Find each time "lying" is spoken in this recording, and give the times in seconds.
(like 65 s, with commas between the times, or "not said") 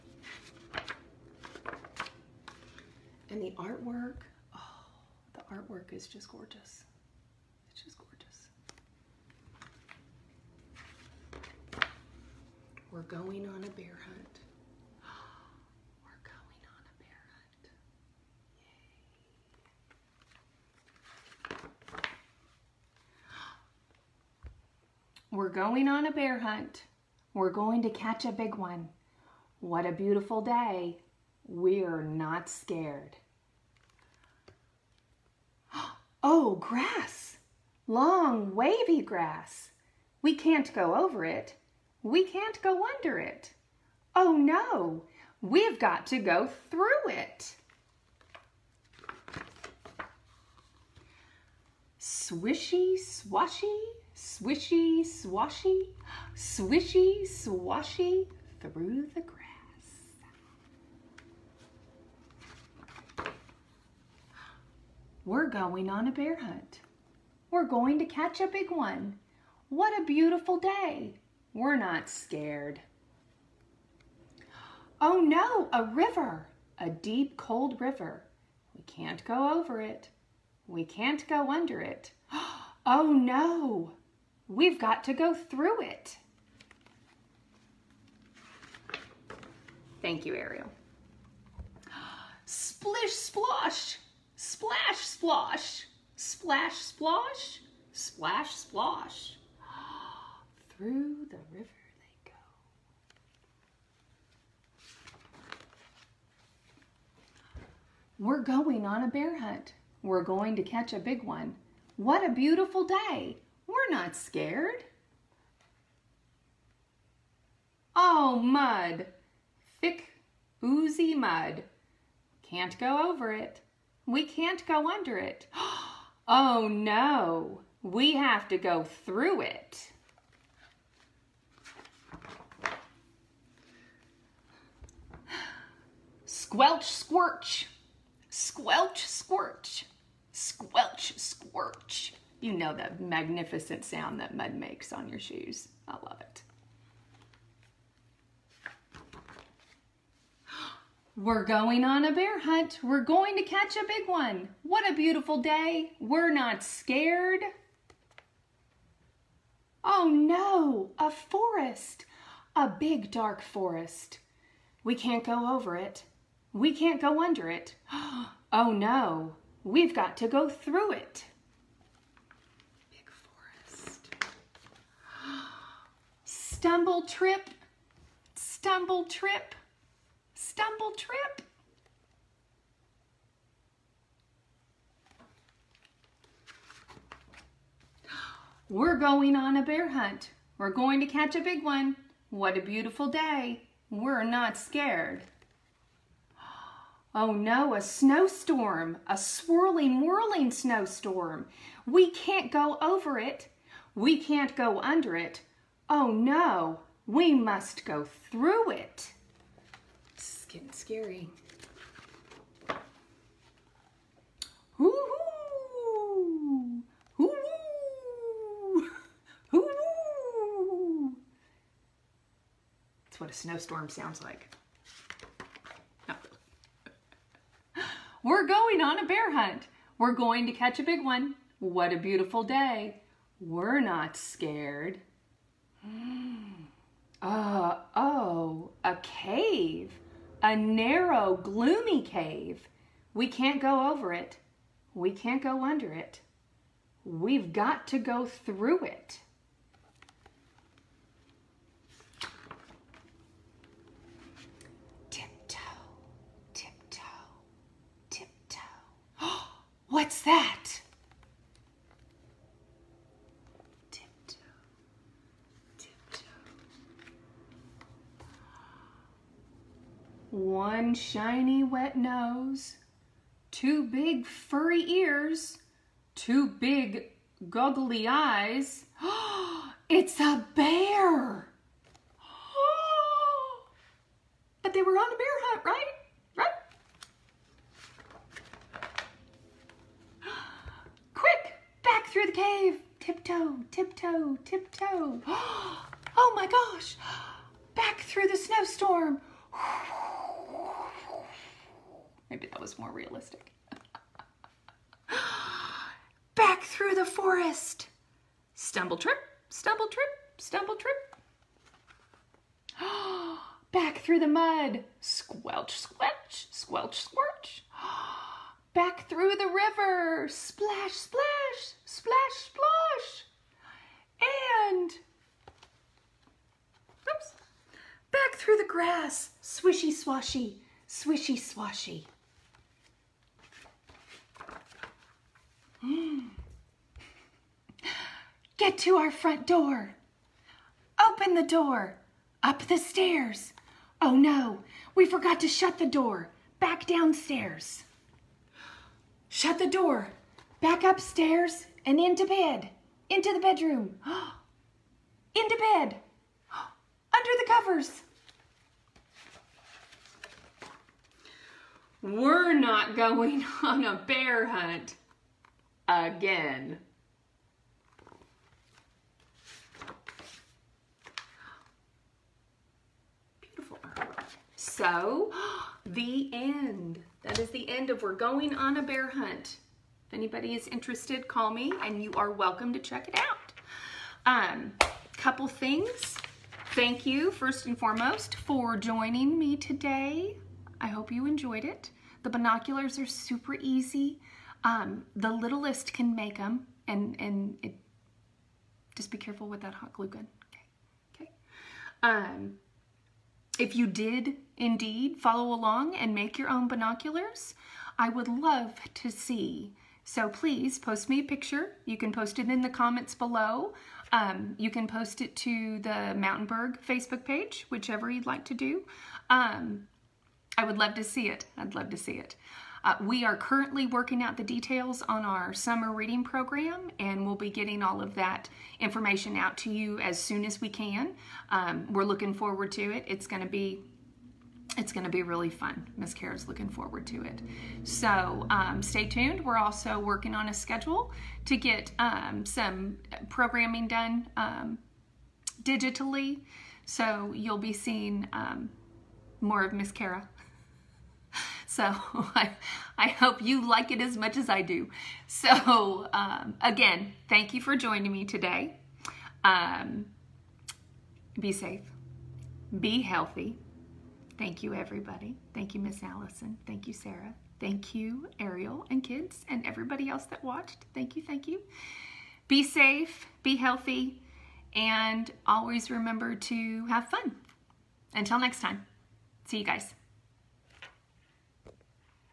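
not said.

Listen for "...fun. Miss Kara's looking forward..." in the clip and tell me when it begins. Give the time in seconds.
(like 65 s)
435 s.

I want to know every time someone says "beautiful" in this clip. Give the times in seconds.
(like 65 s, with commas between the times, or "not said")
29 s, 70 s, 112 s, 154 s, 192 s, 231 s.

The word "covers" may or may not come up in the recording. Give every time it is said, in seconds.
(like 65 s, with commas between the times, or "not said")
357 s.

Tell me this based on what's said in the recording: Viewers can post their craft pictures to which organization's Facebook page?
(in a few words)
Mountainburg.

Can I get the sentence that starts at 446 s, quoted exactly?
So you'll be seeing um, more of Miss Kara.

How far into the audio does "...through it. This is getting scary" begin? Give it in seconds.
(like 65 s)
208 s.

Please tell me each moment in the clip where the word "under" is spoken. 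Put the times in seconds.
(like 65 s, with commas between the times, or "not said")
42 s, 81 s, 124 s, 167 s, 204 s, 245 s, 357 s.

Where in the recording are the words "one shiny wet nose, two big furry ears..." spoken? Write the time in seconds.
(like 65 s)
270 s.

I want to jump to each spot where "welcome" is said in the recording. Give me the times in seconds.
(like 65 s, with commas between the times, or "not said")
382 s.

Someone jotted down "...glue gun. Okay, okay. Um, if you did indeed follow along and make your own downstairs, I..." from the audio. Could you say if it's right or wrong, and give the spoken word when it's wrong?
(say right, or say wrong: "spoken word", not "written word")
wrong: "binoculars", not "downstairs".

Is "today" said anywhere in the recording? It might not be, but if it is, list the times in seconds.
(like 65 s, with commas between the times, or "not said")
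389 s, 458 s.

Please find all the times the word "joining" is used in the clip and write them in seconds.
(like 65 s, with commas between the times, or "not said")
388 s, 457 s.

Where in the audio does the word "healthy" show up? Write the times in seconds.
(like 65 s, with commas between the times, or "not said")
463 s, 473 s.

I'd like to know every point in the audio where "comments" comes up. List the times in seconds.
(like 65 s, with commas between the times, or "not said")
412 s.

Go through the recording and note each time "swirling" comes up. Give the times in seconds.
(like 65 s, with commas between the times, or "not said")
199 s.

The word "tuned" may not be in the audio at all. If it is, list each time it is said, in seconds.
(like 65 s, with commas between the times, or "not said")
439 s.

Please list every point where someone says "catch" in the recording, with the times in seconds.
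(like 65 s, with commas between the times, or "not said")
27 s, 68 s, 110 s, 153 s, 191 s, 230 s.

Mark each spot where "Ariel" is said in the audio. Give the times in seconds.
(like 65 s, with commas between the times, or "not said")
90 s, 468 s.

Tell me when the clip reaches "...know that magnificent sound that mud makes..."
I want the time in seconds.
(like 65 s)
142 s.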